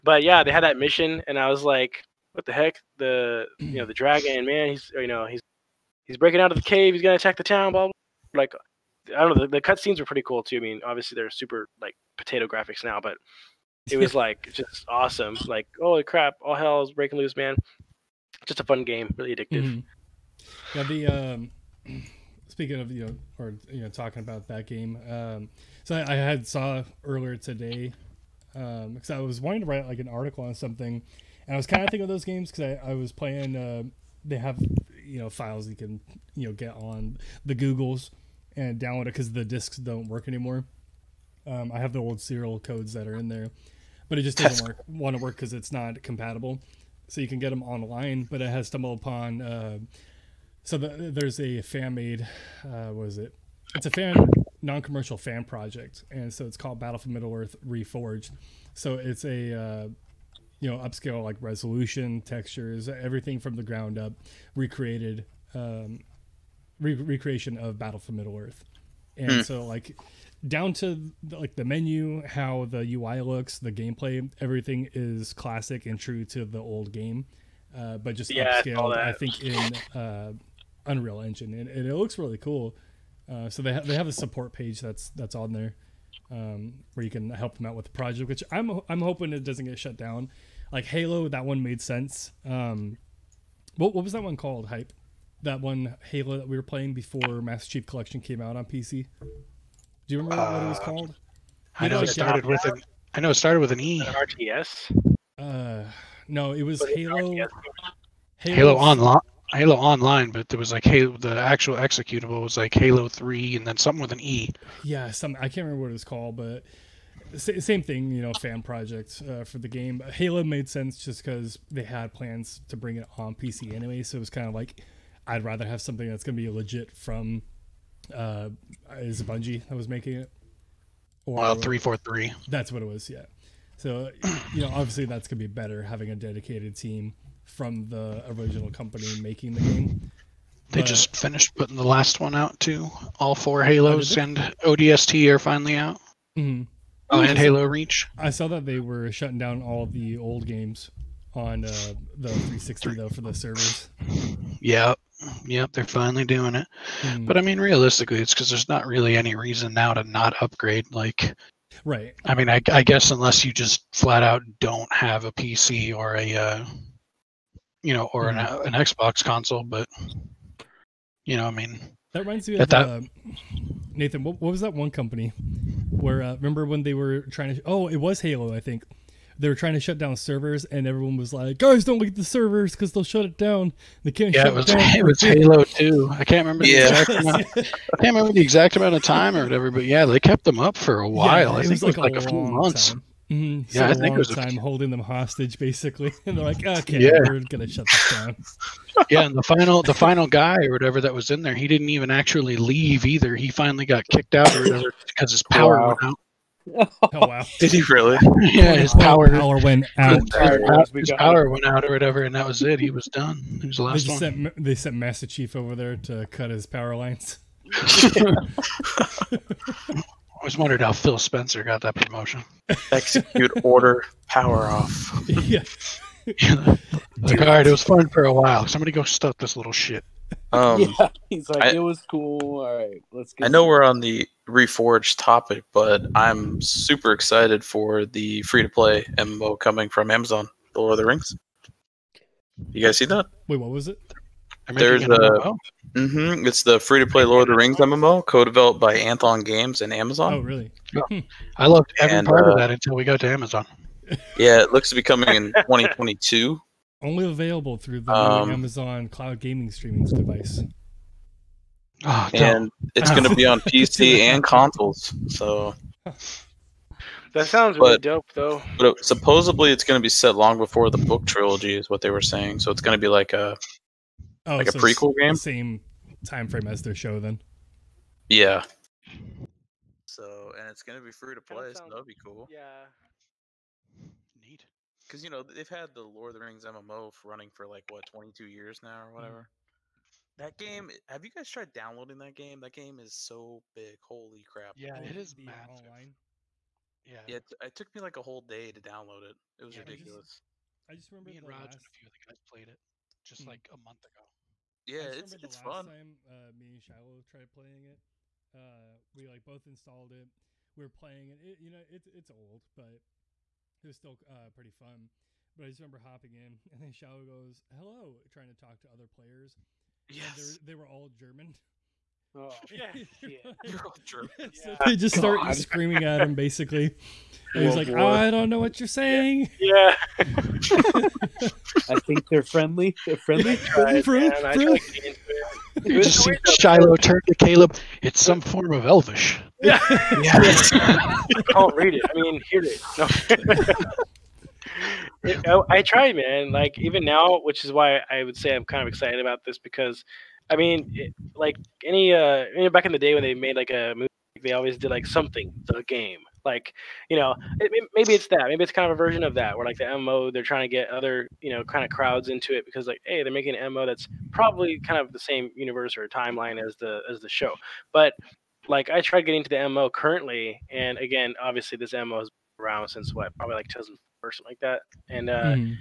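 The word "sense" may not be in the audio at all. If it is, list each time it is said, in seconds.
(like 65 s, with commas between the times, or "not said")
91 s, 120 s.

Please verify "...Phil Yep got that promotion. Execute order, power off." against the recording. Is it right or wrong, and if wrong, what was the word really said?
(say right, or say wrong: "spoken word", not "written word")
wrong: "Spencer", not "Yep".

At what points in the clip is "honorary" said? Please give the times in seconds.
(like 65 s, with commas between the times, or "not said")
not said.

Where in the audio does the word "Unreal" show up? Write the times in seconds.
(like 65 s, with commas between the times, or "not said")
80 s.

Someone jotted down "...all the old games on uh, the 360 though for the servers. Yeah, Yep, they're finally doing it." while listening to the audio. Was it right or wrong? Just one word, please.
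right.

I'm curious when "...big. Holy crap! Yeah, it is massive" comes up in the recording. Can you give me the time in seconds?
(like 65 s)
293 s.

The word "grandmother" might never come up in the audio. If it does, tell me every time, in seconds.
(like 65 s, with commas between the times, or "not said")
not said.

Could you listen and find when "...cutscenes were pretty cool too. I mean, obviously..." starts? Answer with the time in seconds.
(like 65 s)
9 s.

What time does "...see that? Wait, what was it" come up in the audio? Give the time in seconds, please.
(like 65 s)
242 s.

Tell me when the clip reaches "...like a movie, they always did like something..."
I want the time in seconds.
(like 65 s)
353 s.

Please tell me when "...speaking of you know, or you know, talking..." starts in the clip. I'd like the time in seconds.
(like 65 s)
22 s.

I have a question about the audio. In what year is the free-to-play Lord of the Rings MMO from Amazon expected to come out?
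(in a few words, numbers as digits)
2022.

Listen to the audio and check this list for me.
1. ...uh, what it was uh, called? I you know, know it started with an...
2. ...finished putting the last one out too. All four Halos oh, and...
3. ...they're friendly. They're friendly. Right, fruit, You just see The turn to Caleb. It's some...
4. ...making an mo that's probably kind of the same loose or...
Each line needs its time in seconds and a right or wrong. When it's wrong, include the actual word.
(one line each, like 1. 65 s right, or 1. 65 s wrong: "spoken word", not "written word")
1. 100 s right
2. 141 s right
3. 332 s wrong: "Shiloh", not "The"
4. 363 s wrong: "universe", not "loose".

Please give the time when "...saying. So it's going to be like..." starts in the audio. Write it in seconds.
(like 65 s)
272 s.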